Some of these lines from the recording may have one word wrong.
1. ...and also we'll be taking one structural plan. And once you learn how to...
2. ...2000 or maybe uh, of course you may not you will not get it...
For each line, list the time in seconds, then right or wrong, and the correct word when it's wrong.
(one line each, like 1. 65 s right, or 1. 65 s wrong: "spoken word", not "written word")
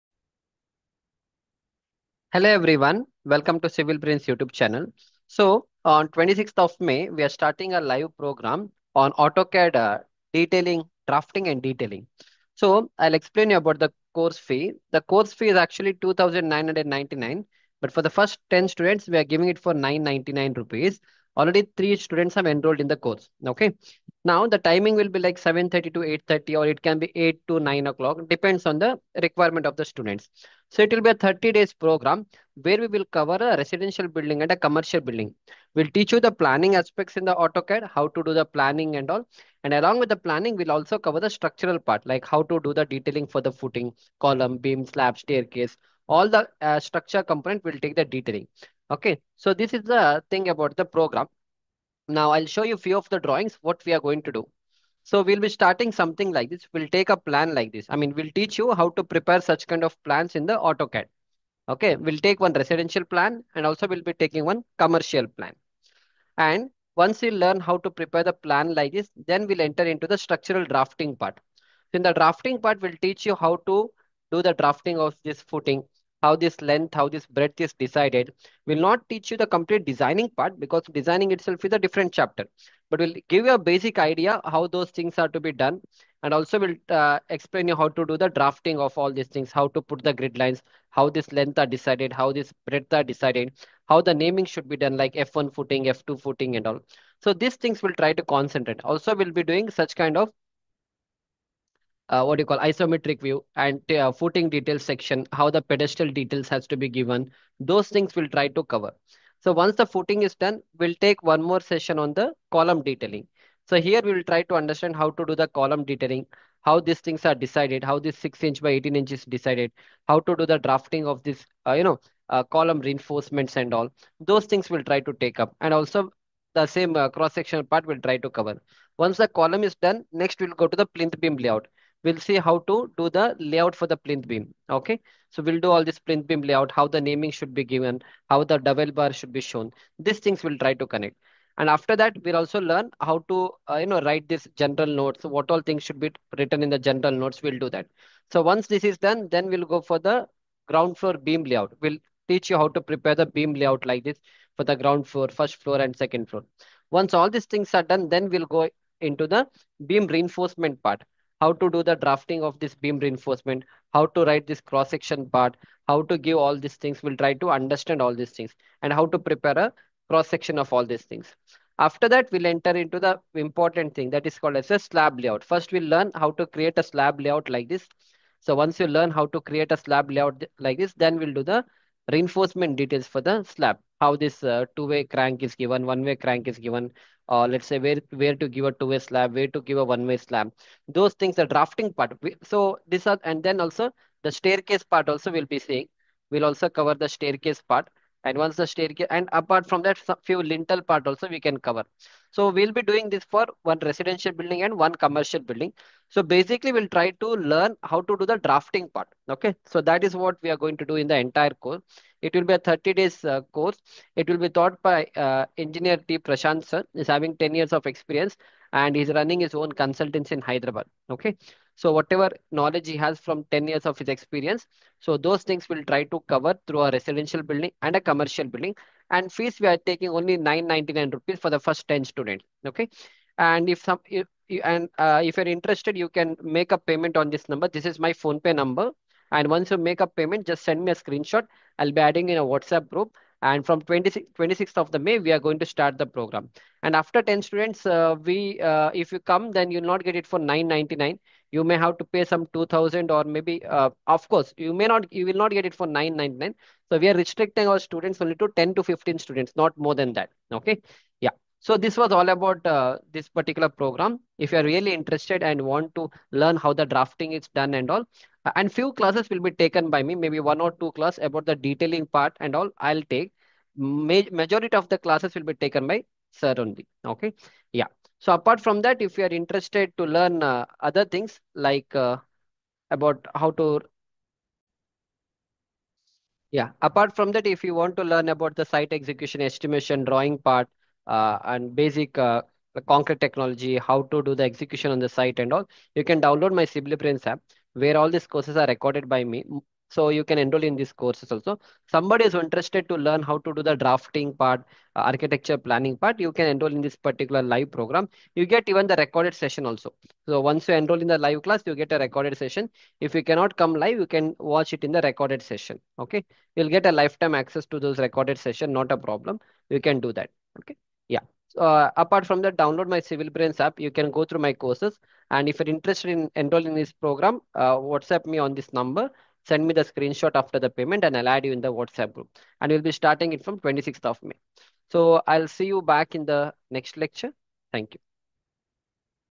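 1. 63 s wrong: "commercial", not "structural"
2. 252 s right.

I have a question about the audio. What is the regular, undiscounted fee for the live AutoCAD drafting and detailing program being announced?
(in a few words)
2,999 rupees.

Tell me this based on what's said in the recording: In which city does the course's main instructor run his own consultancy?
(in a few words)
Hyderabad.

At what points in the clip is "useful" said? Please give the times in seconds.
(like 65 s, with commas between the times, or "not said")
not said.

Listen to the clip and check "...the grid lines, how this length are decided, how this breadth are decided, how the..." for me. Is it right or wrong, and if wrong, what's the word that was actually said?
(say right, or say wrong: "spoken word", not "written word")
right.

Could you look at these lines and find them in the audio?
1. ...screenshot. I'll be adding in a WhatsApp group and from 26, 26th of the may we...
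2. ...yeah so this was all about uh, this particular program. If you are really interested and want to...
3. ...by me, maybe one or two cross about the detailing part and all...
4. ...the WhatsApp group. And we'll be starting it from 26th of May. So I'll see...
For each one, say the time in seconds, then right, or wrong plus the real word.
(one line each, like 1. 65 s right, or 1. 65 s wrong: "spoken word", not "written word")
1. 240 s right
2. 261 s right
3. 269 s wrong: "class", not "cross"
4. 331 s right.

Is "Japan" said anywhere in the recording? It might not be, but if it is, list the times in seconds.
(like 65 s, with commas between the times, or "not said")
not said.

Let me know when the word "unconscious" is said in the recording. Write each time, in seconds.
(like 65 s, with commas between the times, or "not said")
not said.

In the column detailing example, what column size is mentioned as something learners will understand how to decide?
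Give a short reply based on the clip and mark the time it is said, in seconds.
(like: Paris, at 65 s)
6 inch by 18 inch, at 118 s.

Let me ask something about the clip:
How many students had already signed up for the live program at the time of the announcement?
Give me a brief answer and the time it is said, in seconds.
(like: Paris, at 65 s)
3, at 21 s.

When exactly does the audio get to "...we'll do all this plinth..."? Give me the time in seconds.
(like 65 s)
135 s.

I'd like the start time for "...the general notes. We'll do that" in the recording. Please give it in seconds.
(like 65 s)
146 s.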